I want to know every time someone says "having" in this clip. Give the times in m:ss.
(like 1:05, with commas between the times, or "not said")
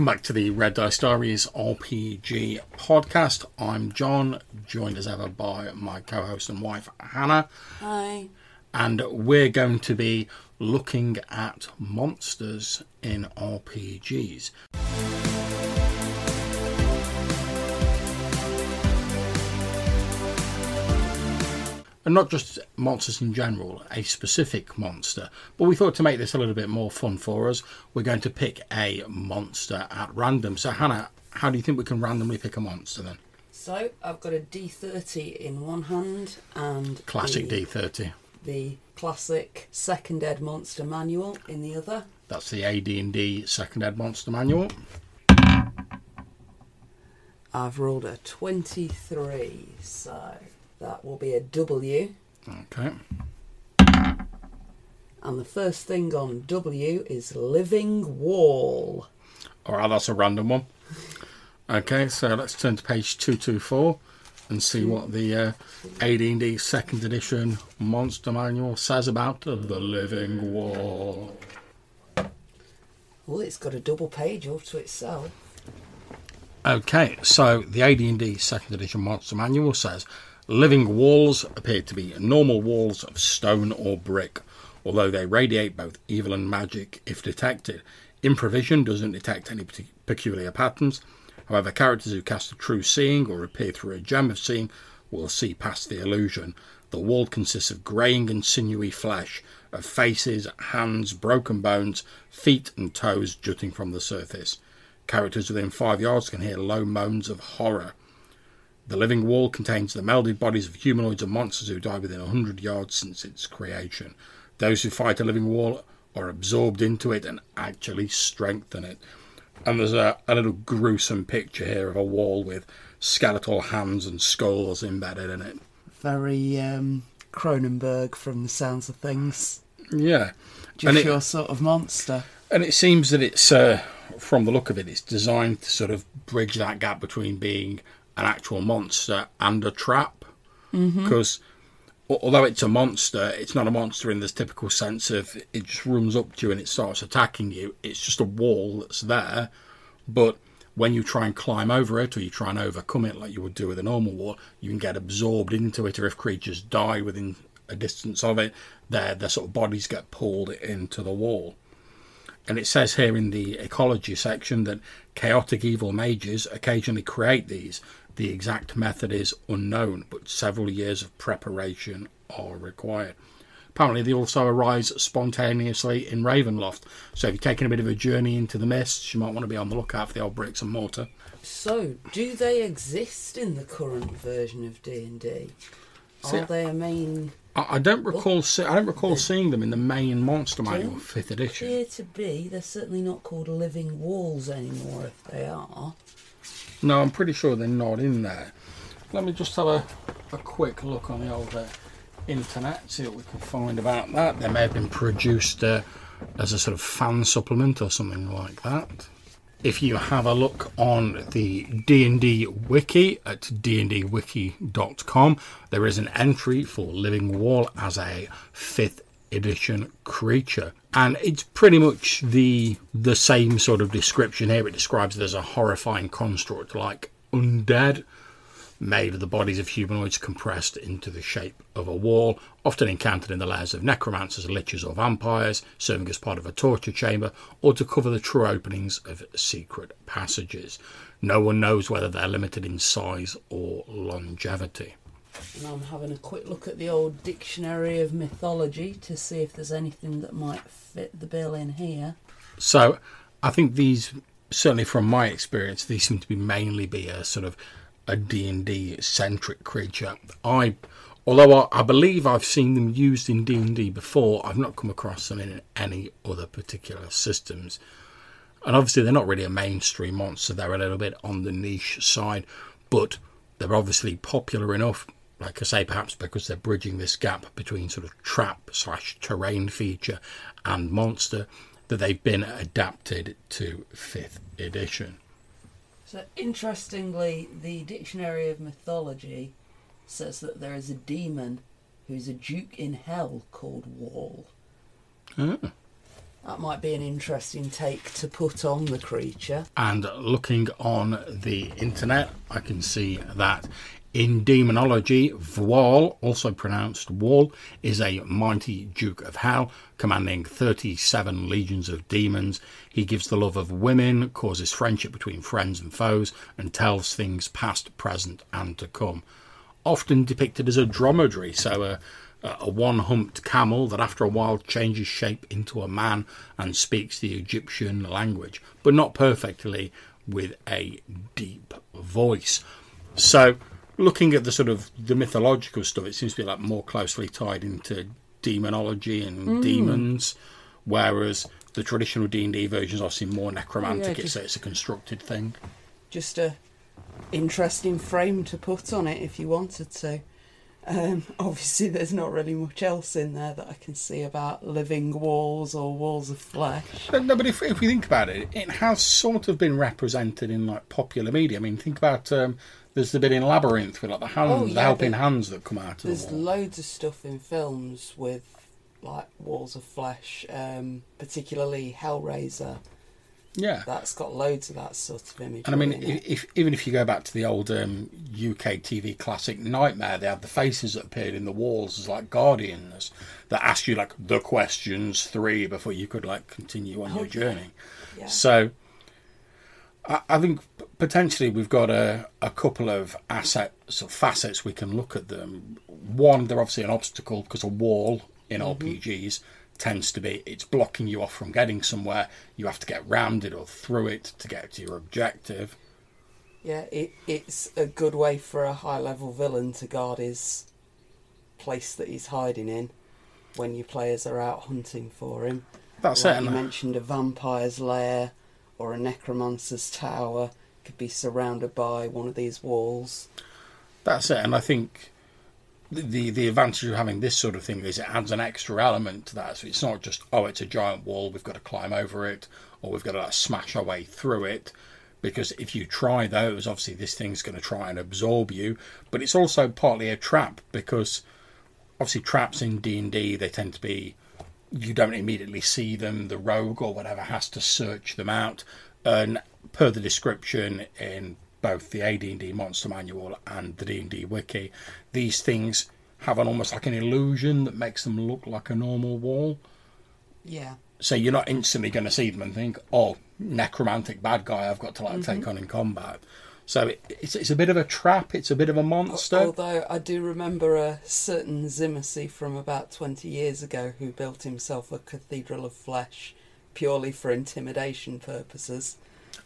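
4:05, 7:06.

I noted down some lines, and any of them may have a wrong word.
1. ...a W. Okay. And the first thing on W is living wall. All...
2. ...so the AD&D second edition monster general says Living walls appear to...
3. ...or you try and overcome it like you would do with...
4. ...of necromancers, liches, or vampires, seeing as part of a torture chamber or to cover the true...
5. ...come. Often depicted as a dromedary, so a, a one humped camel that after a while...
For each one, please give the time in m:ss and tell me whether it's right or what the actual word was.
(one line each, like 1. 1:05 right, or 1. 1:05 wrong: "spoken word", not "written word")
1. 0:51 right
2. 1:17 wrong: "manual", not "general"
3. 2:32 right
4. 3:53 wrong: "serving", not "seeing"
5. 5:18 right.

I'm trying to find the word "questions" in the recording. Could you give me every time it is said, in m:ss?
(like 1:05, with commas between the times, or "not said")
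6:24.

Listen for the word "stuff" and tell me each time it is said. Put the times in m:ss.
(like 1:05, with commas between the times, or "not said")
5:35, 6:06.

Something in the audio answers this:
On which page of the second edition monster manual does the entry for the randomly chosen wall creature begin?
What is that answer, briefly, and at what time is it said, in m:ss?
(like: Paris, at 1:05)
224, at 1:03.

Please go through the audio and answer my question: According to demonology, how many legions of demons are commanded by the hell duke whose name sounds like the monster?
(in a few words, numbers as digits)
37.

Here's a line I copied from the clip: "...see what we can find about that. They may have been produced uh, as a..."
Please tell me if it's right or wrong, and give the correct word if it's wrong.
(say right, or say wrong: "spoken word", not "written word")
right.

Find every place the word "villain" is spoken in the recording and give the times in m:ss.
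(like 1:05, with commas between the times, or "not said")
6:49.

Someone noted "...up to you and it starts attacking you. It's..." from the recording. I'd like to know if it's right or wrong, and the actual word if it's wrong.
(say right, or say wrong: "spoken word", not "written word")
right.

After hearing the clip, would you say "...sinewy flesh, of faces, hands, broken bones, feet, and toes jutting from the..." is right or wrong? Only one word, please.
right.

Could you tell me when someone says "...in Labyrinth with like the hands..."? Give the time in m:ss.
6:03.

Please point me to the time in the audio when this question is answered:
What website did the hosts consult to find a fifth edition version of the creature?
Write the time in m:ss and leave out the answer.
3:33.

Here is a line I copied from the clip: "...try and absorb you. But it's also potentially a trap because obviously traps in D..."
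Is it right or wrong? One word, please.
wrong.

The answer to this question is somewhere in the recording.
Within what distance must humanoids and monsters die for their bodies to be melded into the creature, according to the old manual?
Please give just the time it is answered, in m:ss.
1:52.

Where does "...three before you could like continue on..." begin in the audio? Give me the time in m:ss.
6:25.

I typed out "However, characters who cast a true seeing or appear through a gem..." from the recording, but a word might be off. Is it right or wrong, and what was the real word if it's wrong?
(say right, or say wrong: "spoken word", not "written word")
right.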